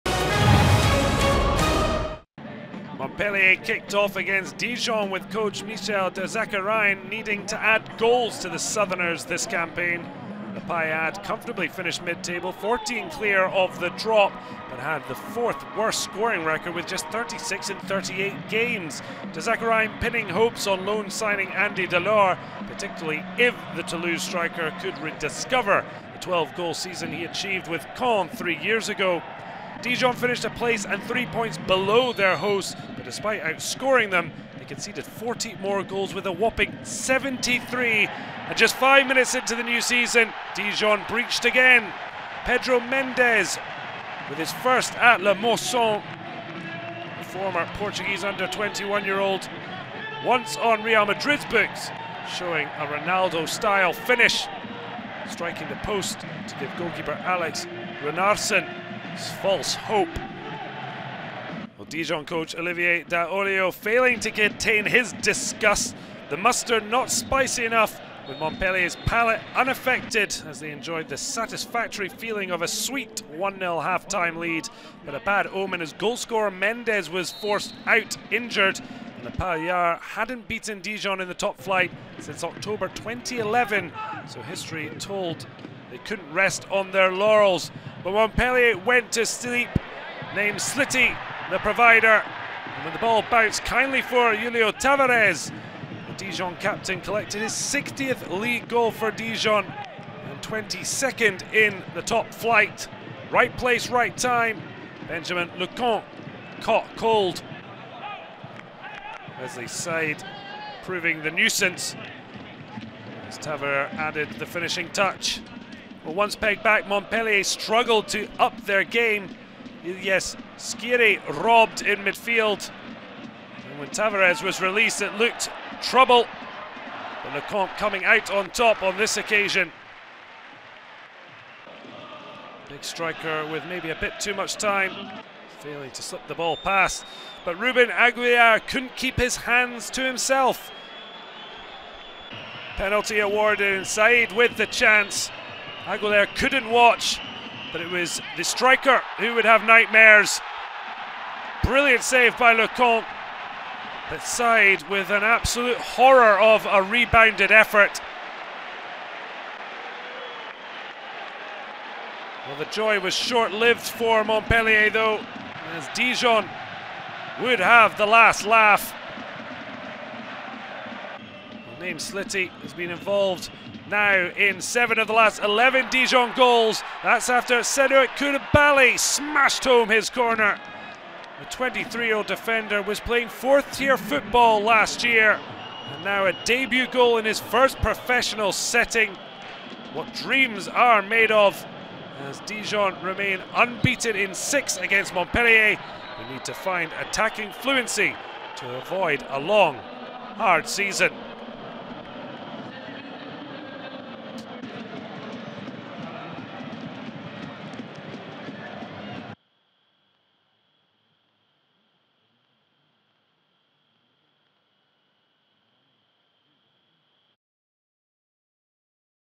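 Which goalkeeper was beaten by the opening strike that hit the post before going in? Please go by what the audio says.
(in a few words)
Alex Runarsson.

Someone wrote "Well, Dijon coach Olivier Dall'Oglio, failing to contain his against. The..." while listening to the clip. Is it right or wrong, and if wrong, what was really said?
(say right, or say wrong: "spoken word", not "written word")
wrong: "disgust", not "against".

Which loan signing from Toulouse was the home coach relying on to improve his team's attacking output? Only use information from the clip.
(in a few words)
Andy Delort.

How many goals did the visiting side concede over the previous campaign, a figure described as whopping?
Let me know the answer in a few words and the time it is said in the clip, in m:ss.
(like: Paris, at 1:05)
73, at 0:36.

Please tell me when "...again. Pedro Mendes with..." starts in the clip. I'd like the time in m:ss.
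0:41.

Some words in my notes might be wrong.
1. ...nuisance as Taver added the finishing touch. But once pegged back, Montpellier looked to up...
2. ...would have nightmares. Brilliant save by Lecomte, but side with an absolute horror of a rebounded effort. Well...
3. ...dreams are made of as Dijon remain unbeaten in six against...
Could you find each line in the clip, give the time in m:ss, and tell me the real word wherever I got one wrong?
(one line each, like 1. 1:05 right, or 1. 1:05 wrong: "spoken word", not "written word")
1. 1:51 wrong: "struggled", not "looked"
2. 2:29 right
3. 3:10 right.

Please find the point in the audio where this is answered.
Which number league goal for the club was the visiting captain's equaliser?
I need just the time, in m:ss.
1:37.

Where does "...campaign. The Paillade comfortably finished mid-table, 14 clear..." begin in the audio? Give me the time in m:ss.
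0:09.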